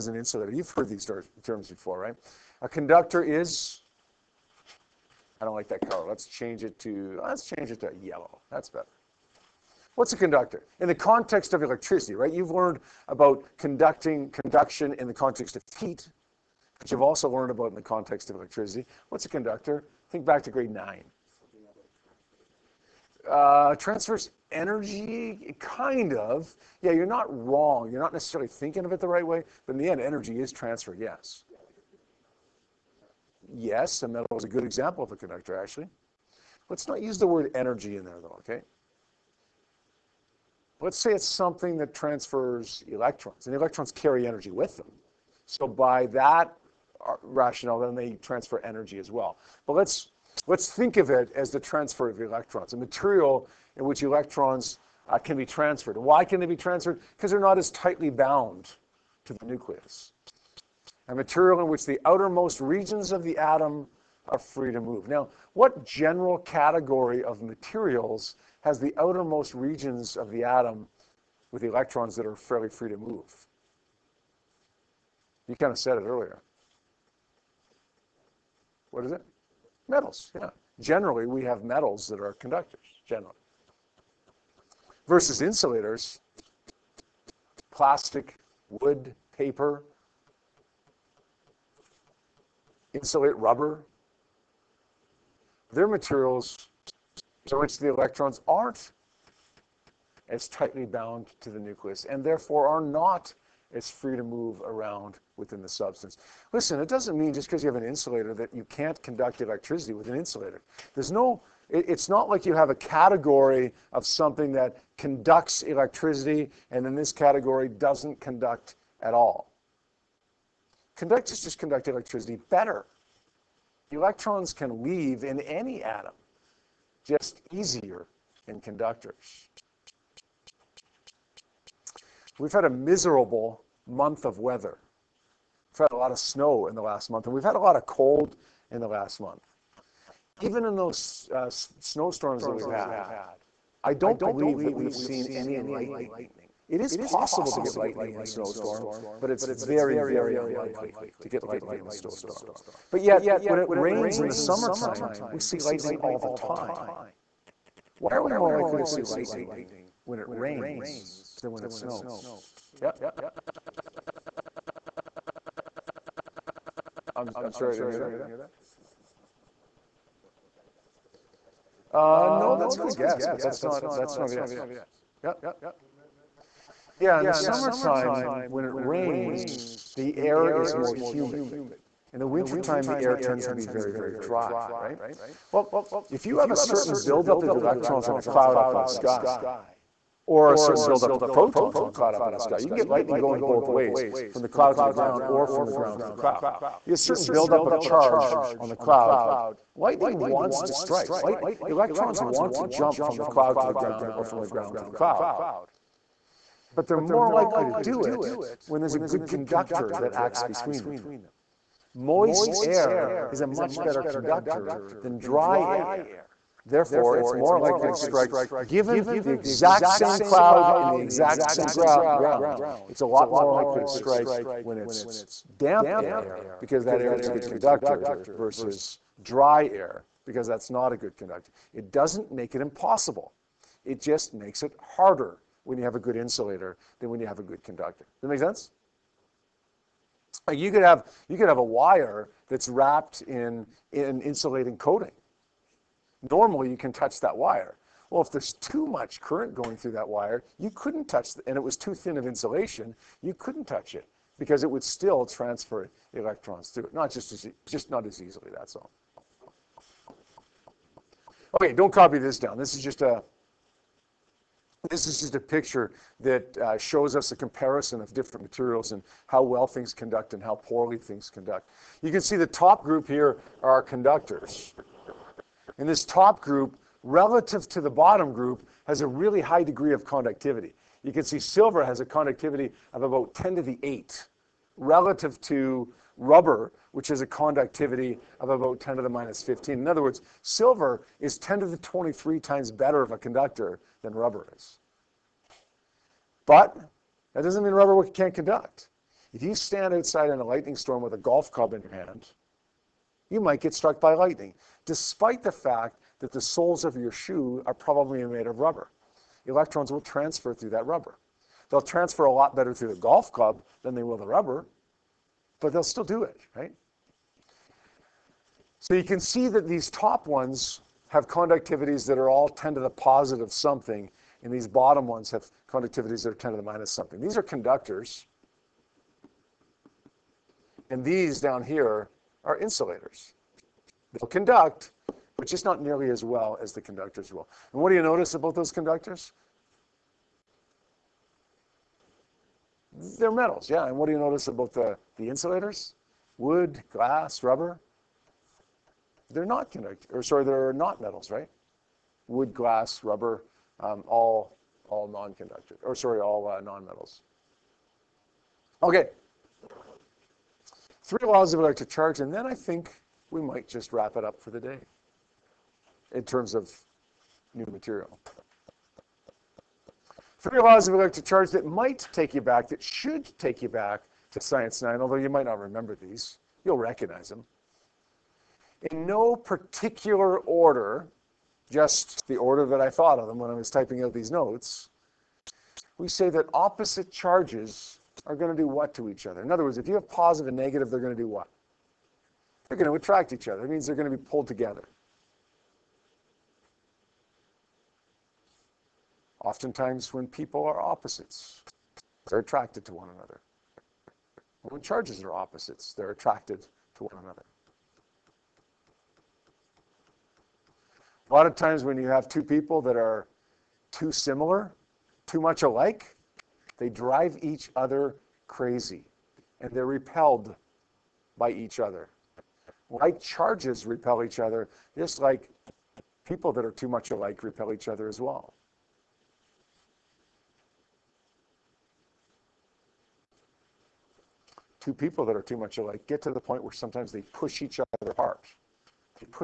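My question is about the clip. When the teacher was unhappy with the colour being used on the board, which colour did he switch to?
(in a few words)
Yellow.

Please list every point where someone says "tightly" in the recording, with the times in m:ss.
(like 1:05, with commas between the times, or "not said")
0:57, 1:40.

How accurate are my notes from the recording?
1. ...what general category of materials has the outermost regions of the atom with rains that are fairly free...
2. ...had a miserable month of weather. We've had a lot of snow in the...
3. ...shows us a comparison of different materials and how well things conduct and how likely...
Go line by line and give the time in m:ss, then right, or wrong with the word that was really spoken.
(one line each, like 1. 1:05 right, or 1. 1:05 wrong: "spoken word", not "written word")
1. 1:05 wrong: "electrons", not "rains"
2. 2:12 right
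3. 4:26 wrong: "poorly", not "likely".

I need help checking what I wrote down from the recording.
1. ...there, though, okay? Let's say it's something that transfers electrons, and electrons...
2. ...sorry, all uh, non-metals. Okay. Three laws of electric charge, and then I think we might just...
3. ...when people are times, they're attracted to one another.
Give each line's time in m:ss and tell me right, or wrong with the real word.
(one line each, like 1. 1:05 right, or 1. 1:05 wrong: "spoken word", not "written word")
1. 0:38 right
2. 5:55 right
3. 6:40 wrong: "opposites", not "times".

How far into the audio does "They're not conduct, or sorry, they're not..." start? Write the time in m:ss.
5:49.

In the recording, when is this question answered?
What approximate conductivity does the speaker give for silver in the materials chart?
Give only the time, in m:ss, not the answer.
4:43.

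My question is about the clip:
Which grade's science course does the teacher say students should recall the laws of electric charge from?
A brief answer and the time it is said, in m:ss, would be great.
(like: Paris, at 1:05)
Science 9, at 6:14.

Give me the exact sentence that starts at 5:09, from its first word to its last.
Electrons will transfer through that rubber.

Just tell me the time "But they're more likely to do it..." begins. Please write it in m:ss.
3:26.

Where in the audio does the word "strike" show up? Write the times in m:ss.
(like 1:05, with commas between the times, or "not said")
3:20, 3:37, 3:43.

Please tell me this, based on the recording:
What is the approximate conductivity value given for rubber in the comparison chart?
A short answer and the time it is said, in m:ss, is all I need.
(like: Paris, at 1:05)
10 to the -15, at 4:48.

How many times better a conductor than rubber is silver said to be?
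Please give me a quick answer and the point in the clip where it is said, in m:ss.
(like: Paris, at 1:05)
10 to the 23, at 4:51.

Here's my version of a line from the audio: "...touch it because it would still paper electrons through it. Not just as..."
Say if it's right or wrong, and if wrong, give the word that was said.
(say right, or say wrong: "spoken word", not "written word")
wrong: "transfer", not "paper".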